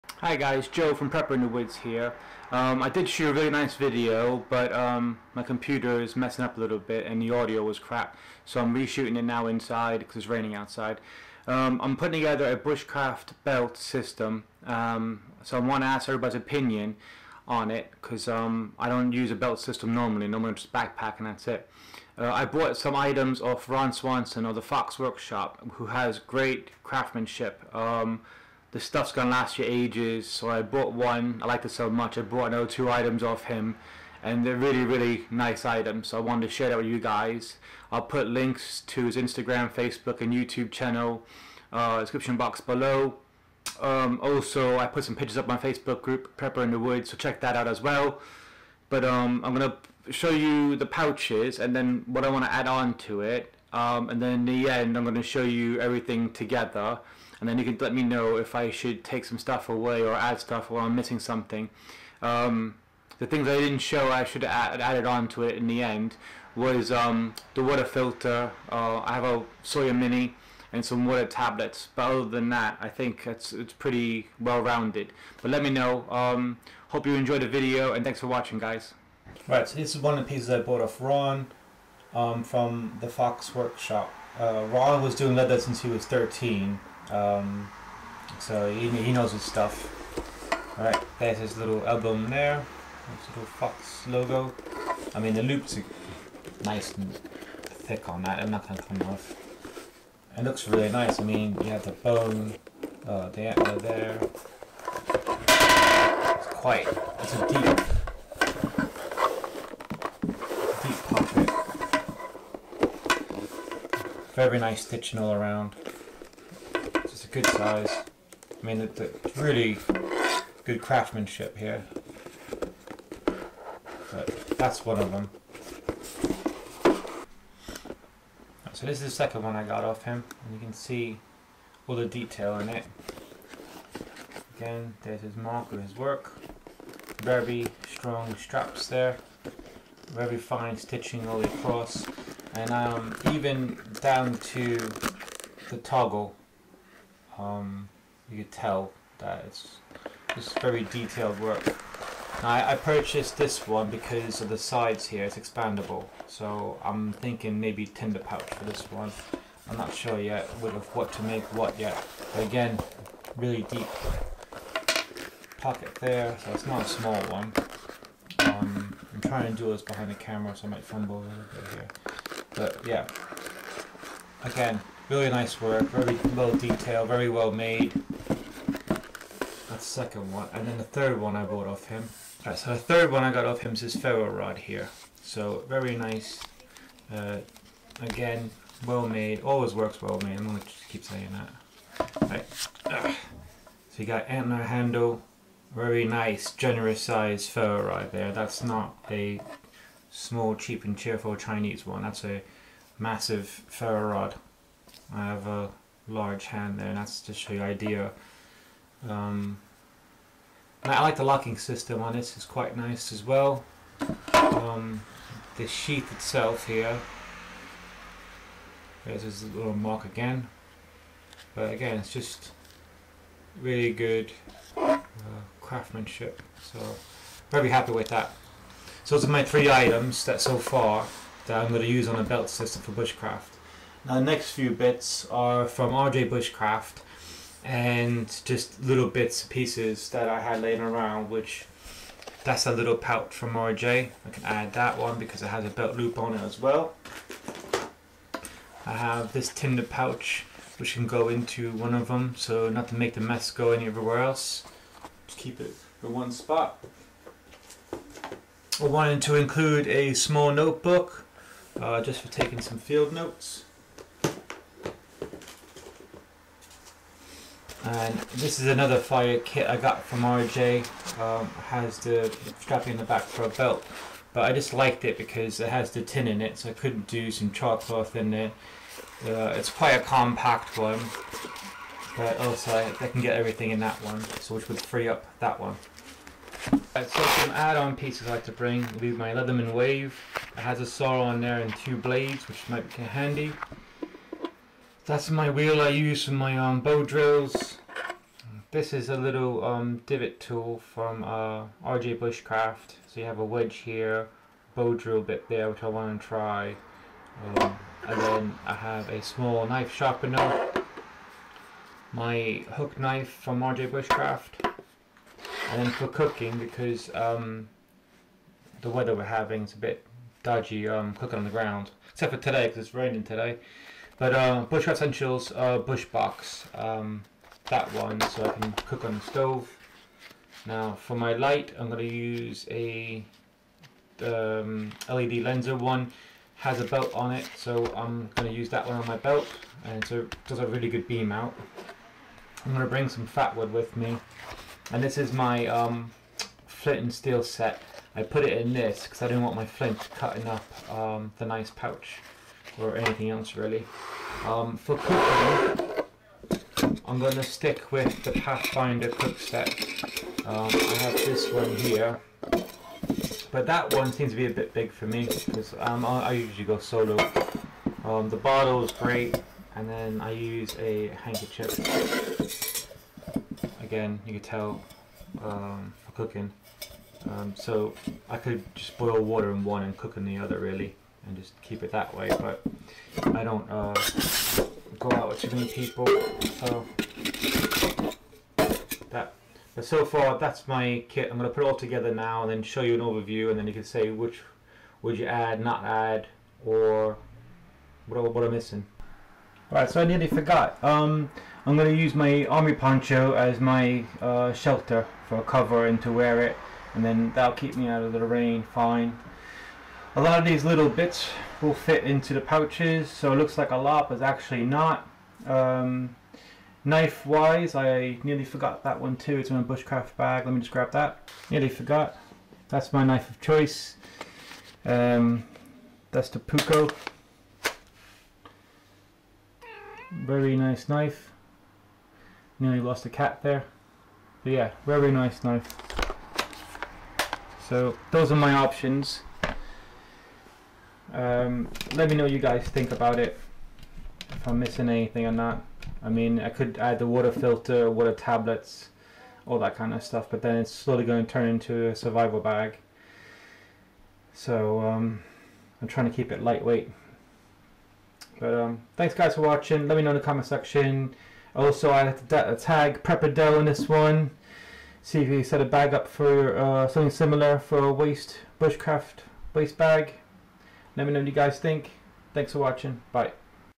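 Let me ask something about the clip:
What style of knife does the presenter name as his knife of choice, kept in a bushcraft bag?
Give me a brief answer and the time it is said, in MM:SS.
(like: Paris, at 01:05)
Puukko, at 07:06.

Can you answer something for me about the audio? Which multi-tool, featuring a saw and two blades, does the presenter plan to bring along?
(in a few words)
Leatherman Wave.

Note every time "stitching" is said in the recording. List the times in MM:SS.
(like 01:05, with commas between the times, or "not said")
01:54, 02:20.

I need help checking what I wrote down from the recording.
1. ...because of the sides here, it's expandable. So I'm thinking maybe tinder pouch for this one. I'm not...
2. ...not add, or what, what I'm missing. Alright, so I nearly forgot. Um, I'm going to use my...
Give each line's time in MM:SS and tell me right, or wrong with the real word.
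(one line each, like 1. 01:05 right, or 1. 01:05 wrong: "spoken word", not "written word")
1. 02:33 right
2. 06:35 right.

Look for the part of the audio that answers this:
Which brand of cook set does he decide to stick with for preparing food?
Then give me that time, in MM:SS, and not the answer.
05:58.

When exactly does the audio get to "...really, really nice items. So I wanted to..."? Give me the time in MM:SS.
00:34.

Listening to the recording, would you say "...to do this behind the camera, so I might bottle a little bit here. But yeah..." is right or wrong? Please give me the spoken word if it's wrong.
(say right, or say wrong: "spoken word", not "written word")
wrong: "fumble", not "bottle".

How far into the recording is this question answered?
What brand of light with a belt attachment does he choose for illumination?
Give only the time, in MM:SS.
05:35.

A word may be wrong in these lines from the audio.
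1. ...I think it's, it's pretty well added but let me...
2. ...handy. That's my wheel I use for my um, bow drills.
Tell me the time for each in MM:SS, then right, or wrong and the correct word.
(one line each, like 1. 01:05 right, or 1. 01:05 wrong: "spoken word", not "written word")
1. 01:12 wrong: "rounded", not "added"
2. 04:53 right.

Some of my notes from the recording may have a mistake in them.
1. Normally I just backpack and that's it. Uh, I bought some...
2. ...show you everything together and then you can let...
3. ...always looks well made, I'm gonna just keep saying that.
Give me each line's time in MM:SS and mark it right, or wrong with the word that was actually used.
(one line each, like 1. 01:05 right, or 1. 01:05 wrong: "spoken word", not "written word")
1. 00:20 right
2. 00:55 right
3. 03:09 wrong: "works", not "looks".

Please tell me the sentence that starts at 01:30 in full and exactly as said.
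Alright, there's his little album there.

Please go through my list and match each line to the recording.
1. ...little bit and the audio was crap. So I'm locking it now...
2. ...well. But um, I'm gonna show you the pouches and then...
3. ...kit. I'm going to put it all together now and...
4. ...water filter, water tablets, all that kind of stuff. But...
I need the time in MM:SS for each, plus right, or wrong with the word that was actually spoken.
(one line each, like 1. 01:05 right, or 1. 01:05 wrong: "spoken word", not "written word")
1. 00:06 wrong: "reshooting", not "locking"
2. 00:47 right
3. 06:31 right
4. 07:27 right.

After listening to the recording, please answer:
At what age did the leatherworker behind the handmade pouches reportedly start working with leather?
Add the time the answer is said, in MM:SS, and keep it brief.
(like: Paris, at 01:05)
13, at 01:26.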